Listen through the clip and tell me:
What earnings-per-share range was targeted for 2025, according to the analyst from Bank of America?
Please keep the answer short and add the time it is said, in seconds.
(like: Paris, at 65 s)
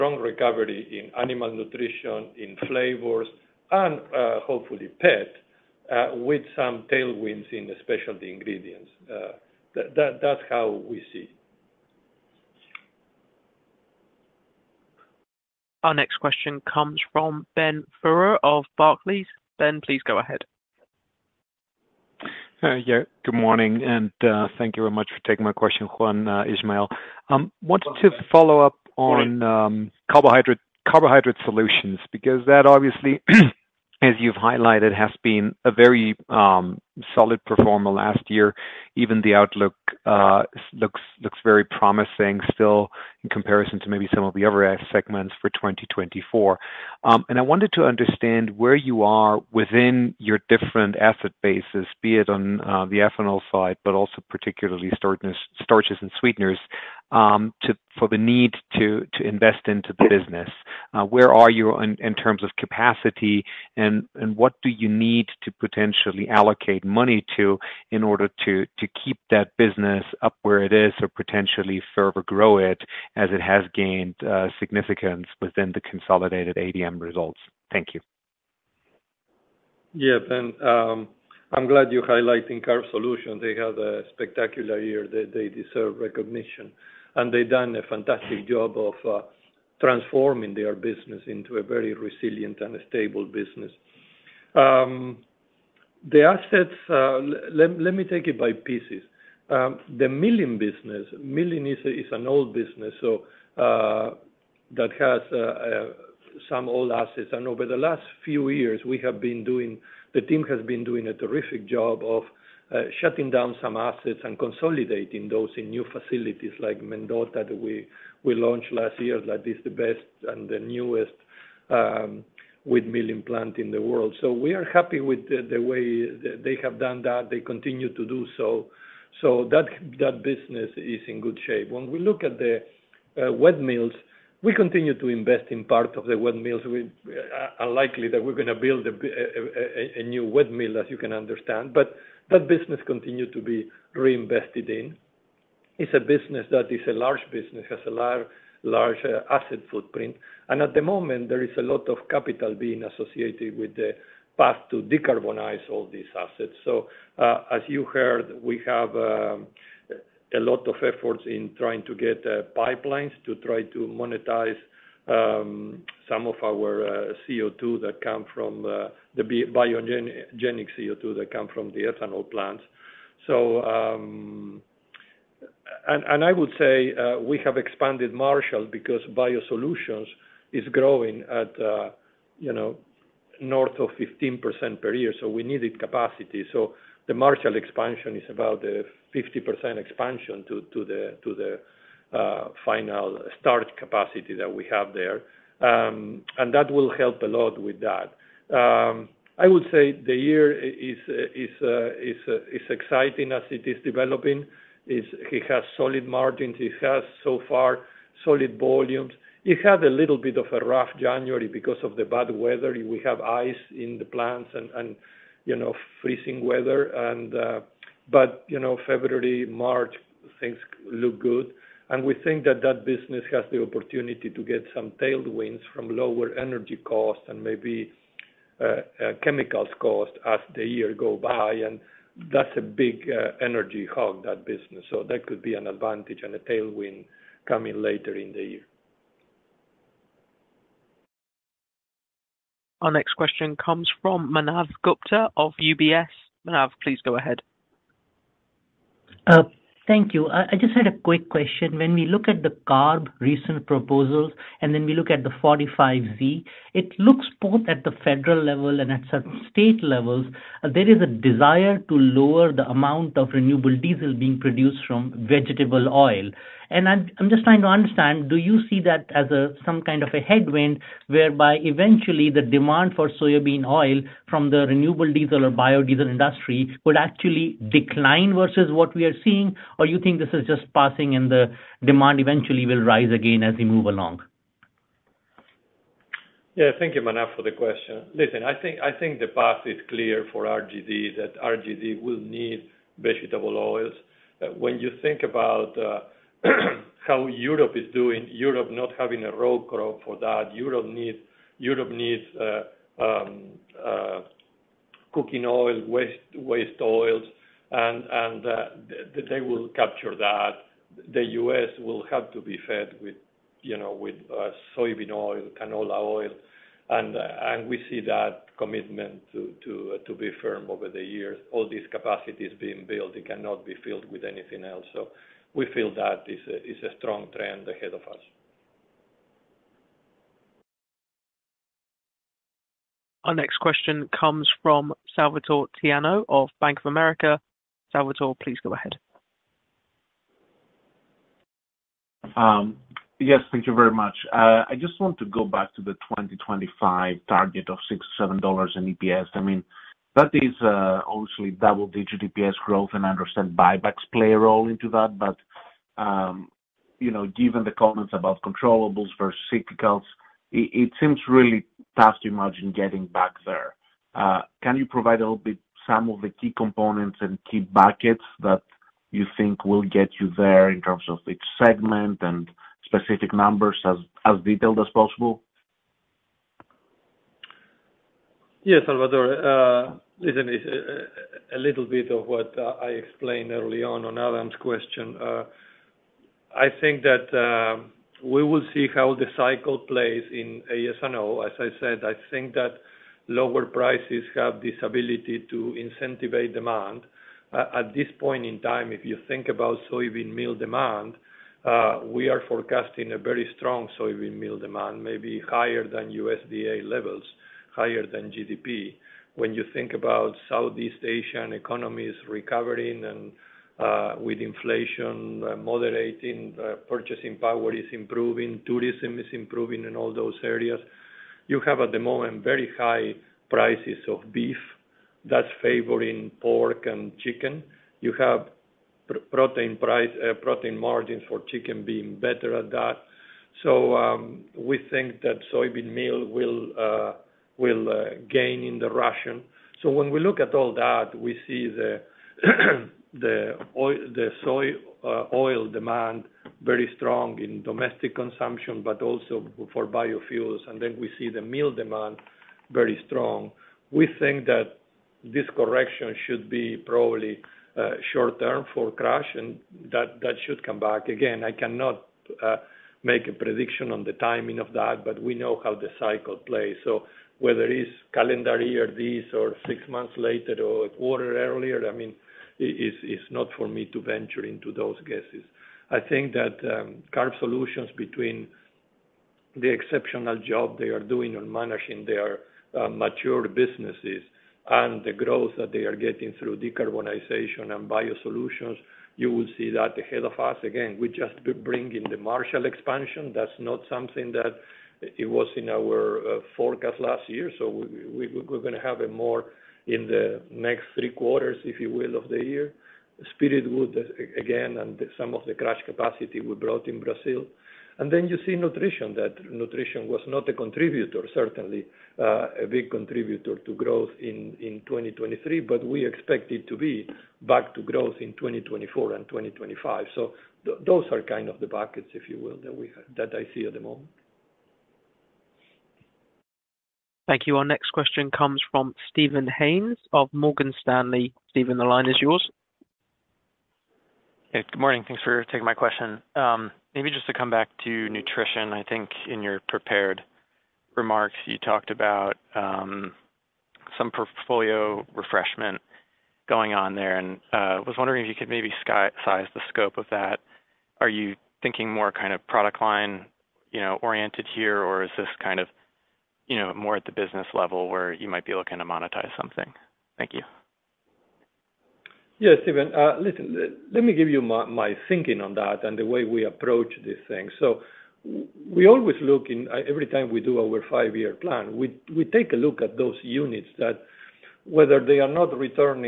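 $6-$7, at 348 s.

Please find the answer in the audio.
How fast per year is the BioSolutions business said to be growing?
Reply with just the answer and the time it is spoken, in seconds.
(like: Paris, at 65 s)
north of 15%, at 183 s.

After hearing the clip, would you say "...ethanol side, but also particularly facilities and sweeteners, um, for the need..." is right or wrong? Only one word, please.
wrong.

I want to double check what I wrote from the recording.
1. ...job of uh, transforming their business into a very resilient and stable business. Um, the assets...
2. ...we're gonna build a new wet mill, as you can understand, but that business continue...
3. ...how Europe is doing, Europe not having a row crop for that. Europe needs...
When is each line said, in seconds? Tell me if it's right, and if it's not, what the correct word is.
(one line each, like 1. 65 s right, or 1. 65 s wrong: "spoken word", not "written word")
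1. 88 s right
2. 138 s right
3. 297 s right.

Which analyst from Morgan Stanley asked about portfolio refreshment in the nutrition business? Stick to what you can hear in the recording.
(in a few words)
Steven Haynes.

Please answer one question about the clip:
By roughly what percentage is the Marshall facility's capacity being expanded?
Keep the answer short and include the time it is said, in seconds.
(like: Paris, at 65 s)
50%, at 189 s.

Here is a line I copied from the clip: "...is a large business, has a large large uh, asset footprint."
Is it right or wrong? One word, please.
right.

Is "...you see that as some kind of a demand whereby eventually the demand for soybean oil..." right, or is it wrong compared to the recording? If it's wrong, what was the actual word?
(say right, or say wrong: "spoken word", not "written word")
wrong: "headwind", not "demand".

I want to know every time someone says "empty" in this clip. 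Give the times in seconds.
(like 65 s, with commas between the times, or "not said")
not said.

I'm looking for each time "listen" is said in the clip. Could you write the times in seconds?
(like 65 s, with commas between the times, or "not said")
288 s, 380 s, 563 s.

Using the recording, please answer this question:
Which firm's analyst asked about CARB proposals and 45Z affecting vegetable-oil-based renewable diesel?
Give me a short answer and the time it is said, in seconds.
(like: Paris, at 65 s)
UBS, at 245 s.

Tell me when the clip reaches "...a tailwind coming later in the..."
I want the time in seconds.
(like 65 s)
236 s.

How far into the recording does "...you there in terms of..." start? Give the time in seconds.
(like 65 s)
370 s.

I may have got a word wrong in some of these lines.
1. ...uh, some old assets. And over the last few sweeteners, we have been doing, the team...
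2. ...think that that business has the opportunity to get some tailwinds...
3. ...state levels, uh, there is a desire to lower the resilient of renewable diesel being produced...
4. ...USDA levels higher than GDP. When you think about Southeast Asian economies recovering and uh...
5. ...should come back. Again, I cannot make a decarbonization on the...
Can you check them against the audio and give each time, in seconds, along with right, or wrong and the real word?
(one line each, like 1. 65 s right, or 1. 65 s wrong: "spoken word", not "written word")
1. 105 s wrong: "years", not "sweeteners"
2. 222 s right
3. 259 s wrong: "amount", not "resilient"
4. 406 s right
5. 460 s wrong: "prediction", not "decarbonization".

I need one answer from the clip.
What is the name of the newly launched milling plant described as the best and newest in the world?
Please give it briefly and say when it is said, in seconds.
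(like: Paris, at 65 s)
Mendota, at 116 s.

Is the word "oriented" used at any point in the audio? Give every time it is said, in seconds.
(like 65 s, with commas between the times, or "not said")
554 s.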